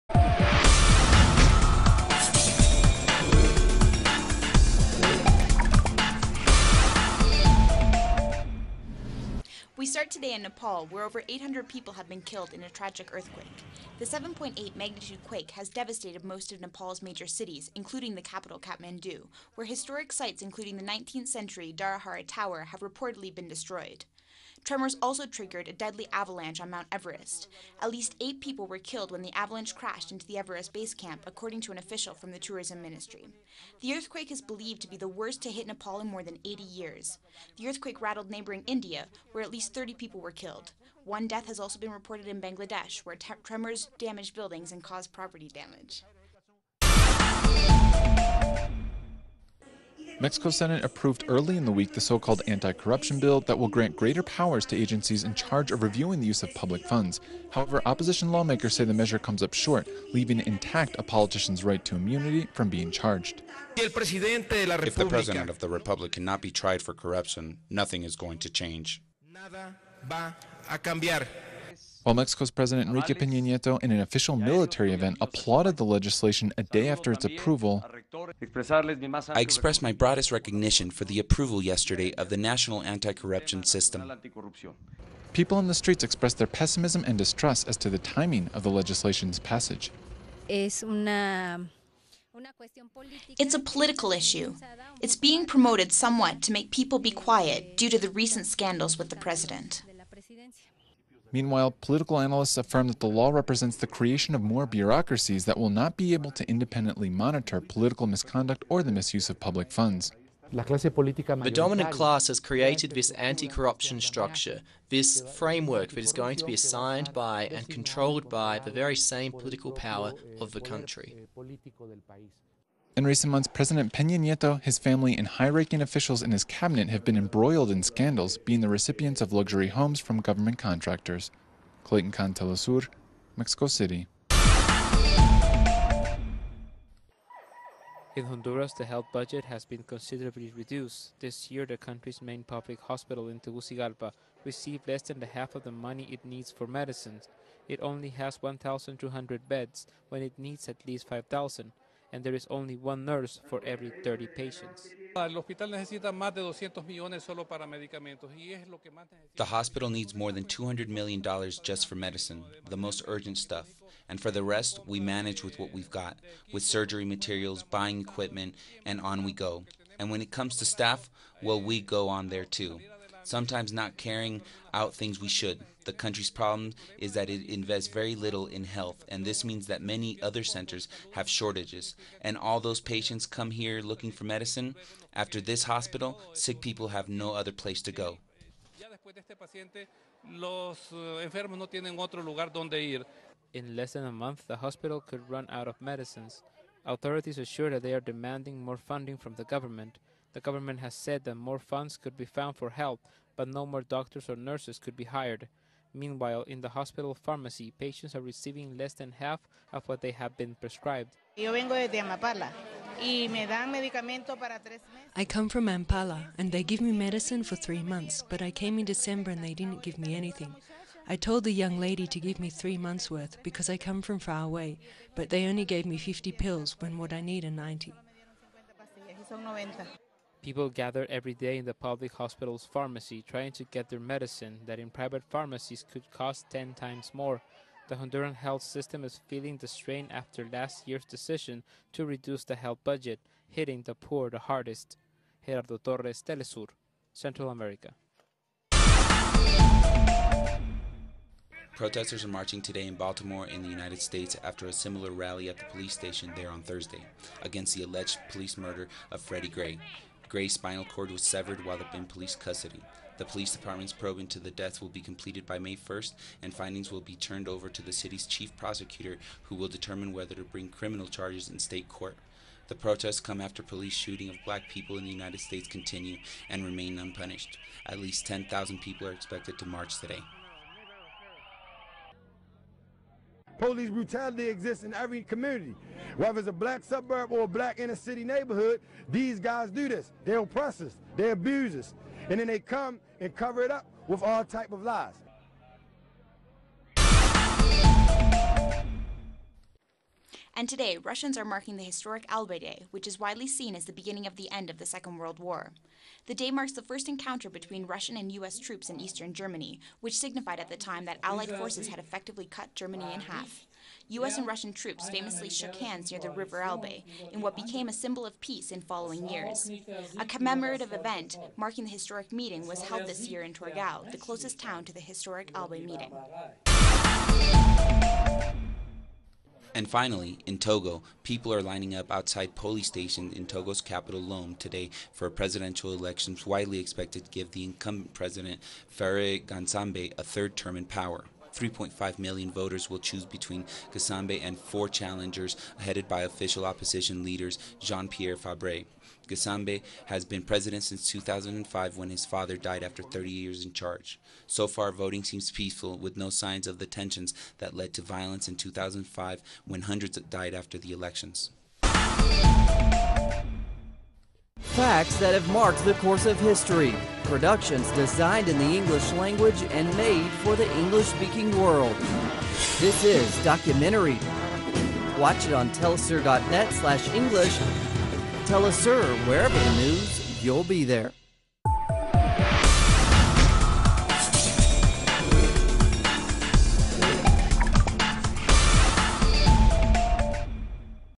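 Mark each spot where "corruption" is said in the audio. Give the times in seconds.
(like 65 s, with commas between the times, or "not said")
52 s, 66 s, 83 s, 113 s.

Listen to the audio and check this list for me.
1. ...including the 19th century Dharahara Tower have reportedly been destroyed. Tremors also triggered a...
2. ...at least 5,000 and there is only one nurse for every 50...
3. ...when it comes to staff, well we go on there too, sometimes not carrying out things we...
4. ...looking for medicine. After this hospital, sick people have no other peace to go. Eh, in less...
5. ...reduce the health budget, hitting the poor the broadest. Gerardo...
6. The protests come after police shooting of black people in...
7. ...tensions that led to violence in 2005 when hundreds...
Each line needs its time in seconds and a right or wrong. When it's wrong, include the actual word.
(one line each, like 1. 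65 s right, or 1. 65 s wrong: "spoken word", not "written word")
1. 20 s right
2. 150 s wrong: "30", not "50"
3. 170 s right
4. 183 s wrong: "place", not "peace"
5. 242 s wrong: "hardest", not "broadest"
6. 272 s right
7. 356 s right.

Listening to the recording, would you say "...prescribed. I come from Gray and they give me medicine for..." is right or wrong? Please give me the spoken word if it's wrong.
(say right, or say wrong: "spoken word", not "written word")
wrong: "Ampala", not "Gray".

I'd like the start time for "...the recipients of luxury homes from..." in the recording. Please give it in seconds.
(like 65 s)
128 s.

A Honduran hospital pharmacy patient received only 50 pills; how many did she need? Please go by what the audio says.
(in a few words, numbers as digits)
90.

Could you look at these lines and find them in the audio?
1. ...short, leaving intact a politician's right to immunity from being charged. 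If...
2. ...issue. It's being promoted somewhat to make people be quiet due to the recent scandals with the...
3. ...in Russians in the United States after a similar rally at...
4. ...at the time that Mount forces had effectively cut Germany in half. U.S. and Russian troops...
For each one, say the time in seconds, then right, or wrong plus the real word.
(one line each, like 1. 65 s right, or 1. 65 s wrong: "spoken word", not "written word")
1. 59 s right
2. 94 s right
3. 252 s wrong: "Baltimore", not "Russians"
4. 310 s wrong: "Allied", not "Mount".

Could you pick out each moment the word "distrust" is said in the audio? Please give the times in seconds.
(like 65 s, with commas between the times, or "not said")
87 s.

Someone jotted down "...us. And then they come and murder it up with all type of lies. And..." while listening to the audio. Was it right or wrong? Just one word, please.
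wrong.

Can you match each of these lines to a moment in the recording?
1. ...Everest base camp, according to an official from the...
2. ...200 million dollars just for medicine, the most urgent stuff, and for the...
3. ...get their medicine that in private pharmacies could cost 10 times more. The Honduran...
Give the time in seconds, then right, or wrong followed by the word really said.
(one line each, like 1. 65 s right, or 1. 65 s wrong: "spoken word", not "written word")
1. 30 s right
2. 160 s right
3. 233 s right.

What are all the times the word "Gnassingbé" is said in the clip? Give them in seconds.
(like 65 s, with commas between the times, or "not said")
339 s, 343 s, 349 s.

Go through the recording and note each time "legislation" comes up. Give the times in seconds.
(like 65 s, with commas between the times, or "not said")
75 s, 88 s.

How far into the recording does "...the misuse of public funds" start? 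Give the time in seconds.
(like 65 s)
108 s.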